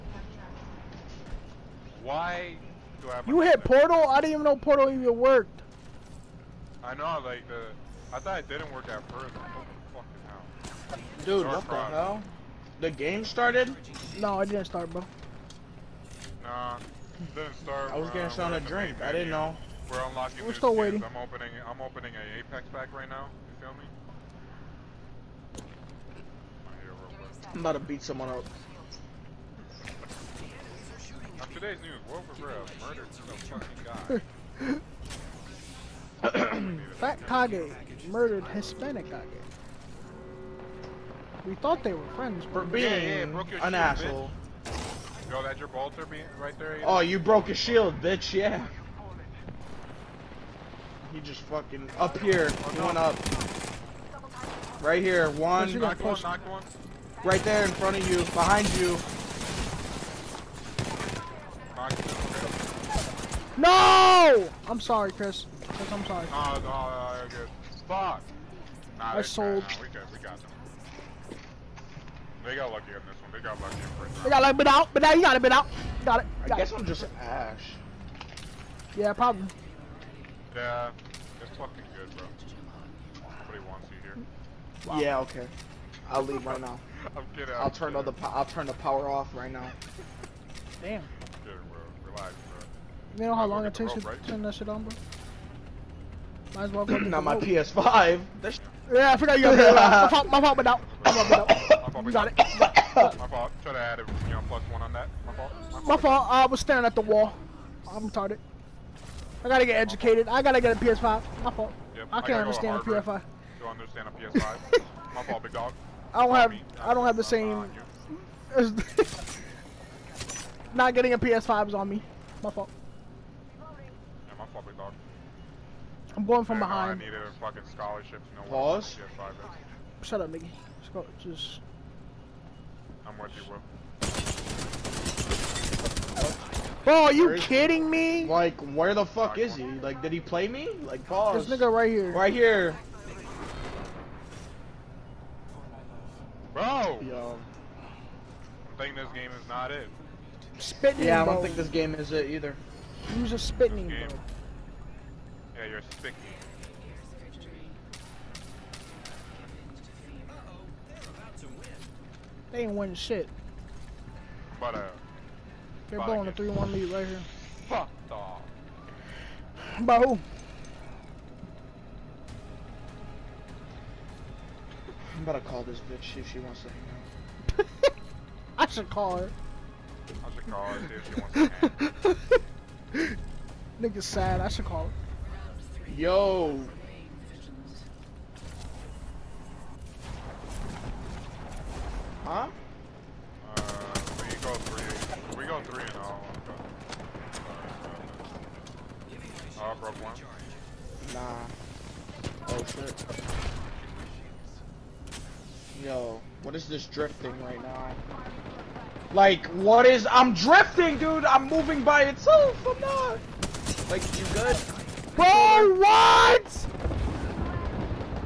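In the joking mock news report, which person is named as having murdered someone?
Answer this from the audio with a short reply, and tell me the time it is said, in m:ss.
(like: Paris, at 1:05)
Wolf of Rev, at 0:32.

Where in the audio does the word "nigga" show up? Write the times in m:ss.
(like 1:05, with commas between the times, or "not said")
2:10, 2:21, 3:03.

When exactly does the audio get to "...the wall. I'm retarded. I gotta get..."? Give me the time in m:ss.
1:46.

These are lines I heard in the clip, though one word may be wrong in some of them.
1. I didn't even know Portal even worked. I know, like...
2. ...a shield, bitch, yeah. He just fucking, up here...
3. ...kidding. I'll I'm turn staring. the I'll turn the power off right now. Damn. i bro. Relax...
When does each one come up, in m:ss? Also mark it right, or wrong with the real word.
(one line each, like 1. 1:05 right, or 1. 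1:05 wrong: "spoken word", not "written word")
1. 0:04 right
2. 0:47 right
3. 1:27 wrong: "kidding", not "staring".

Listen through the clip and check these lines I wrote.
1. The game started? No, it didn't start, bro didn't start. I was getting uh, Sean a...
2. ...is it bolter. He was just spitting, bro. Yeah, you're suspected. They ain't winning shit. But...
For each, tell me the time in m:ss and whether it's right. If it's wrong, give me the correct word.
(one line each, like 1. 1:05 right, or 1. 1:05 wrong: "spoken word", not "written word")
1. 0:12 right
2. 2:31 wrong: "either", not "bolter".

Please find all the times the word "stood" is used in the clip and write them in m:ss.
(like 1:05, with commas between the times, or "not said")
not said.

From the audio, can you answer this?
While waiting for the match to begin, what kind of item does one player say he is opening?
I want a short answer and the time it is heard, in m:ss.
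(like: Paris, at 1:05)
Apex pack, at 0:22.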